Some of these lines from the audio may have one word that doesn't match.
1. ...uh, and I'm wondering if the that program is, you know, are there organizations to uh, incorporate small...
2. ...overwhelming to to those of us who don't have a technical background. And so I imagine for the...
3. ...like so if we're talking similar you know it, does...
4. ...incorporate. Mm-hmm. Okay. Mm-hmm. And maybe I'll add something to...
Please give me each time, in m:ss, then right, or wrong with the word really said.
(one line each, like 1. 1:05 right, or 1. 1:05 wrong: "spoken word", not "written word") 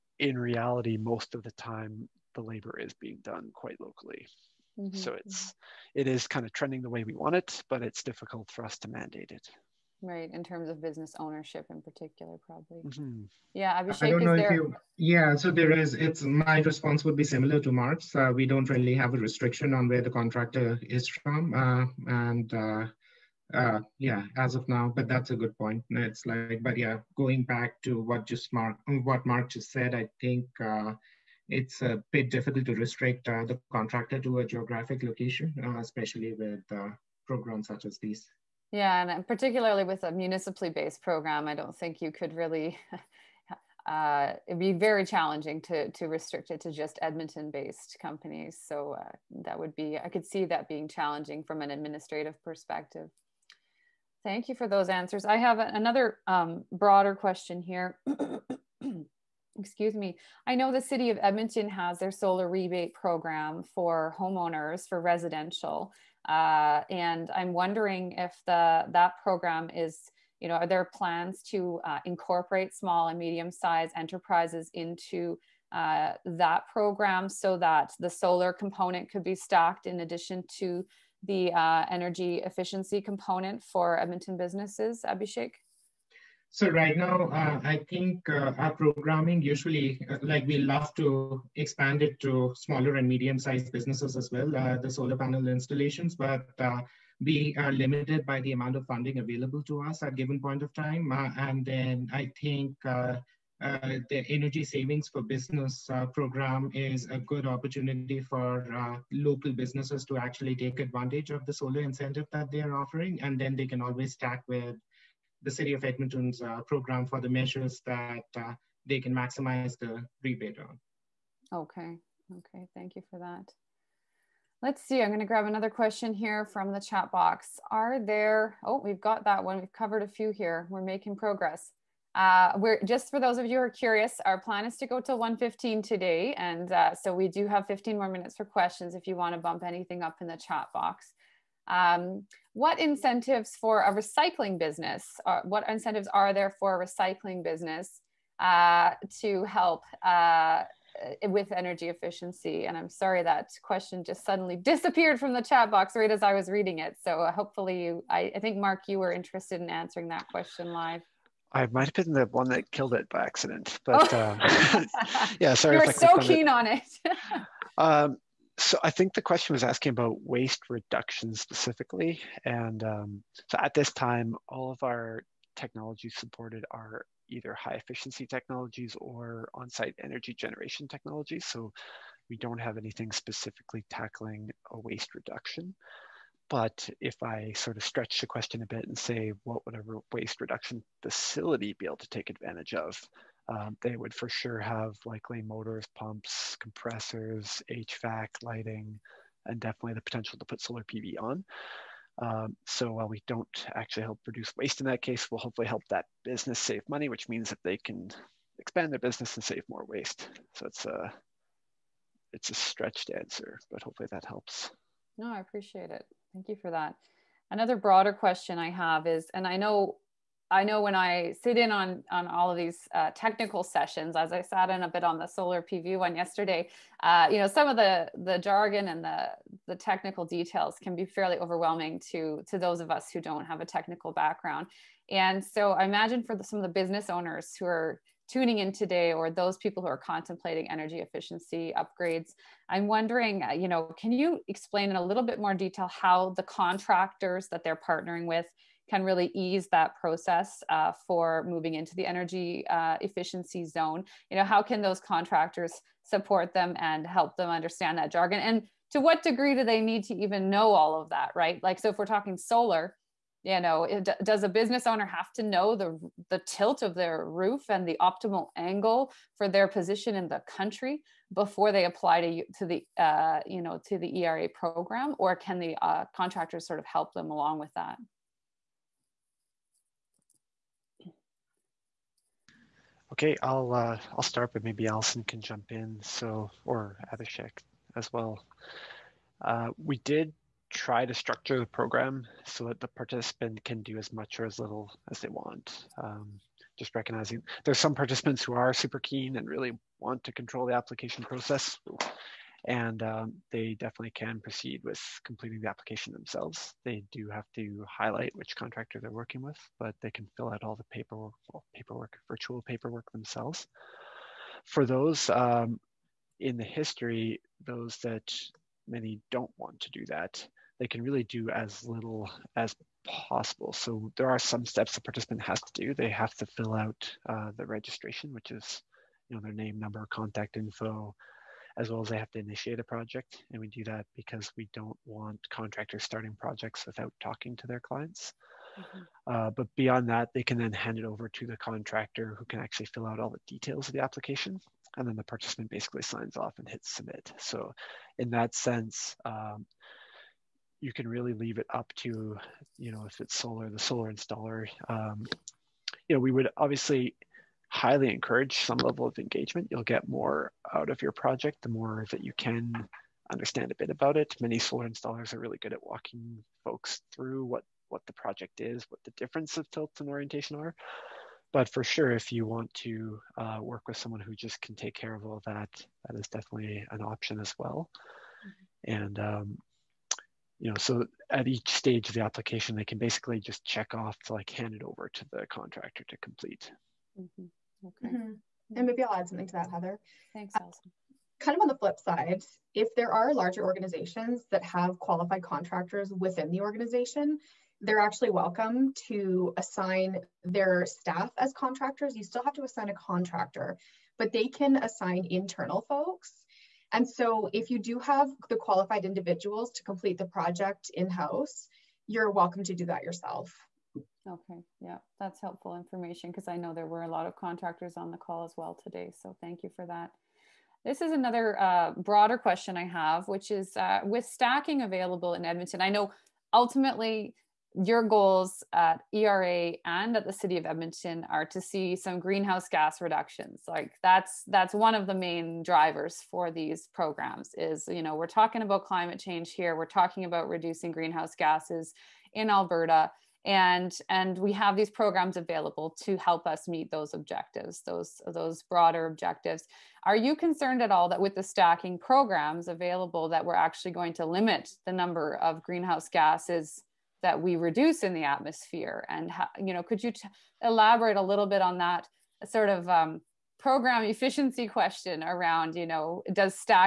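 1. 1:06 wrong: "plans", not "organizations"
2. 3:51 right
3. 4:21 wrong: "solar", not "similar"
4. 6:26 wrong: "complete", not "incorporate".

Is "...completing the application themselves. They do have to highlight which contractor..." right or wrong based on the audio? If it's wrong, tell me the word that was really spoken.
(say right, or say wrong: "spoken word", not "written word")
right.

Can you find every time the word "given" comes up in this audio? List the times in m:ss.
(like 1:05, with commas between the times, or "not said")
1:40.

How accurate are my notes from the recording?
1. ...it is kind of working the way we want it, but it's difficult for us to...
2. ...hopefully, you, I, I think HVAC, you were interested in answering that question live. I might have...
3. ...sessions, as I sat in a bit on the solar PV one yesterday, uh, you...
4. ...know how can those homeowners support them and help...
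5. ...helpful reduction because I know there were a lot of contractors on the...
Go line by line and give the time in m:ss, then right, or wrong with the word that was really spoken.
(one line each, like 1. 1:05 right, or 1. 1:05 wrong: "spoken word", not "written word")
1. 0:05 wrong: "trending", not "working"
2. 2:37 wrong: "Marc", not "HVAC"
3. 3:43 right
4. 4:14 wrong: "contractors", not "homeowners"
5. 6:55 wrong: "information", not "reduction".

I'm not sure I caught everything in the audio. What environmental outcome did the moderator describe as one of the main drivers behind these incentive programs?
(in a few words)
Greenhouse gas reductions.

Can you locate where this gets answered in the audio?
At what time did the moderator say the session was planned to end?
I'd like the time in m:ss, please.
2:15.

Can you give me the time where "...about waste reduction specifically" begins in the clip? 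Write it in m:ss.
2:49.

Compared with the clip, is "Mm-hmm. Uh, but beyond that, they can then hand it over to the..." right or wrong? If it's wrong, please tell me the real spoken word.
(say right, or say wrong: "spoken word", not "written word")
right.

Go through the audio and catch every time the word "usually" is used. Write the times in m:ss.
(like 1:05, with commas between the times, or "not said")
1:29.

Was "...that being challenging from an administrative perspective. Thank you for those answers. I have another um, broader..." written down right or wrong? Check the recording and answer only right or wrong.
right.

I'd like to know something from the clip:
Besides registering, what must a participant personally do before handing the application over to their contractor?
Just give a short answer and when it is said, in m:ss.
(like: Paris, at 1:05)
Initiate a project, at 5:32.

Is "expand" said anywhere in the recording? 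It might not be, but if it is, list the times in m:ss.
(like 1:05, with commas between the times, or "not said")
1:31, 3:28.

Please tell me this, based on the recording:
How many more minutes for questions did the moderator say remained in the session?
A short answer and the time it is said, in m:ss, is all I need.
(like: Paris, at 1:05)
15, at 2:17.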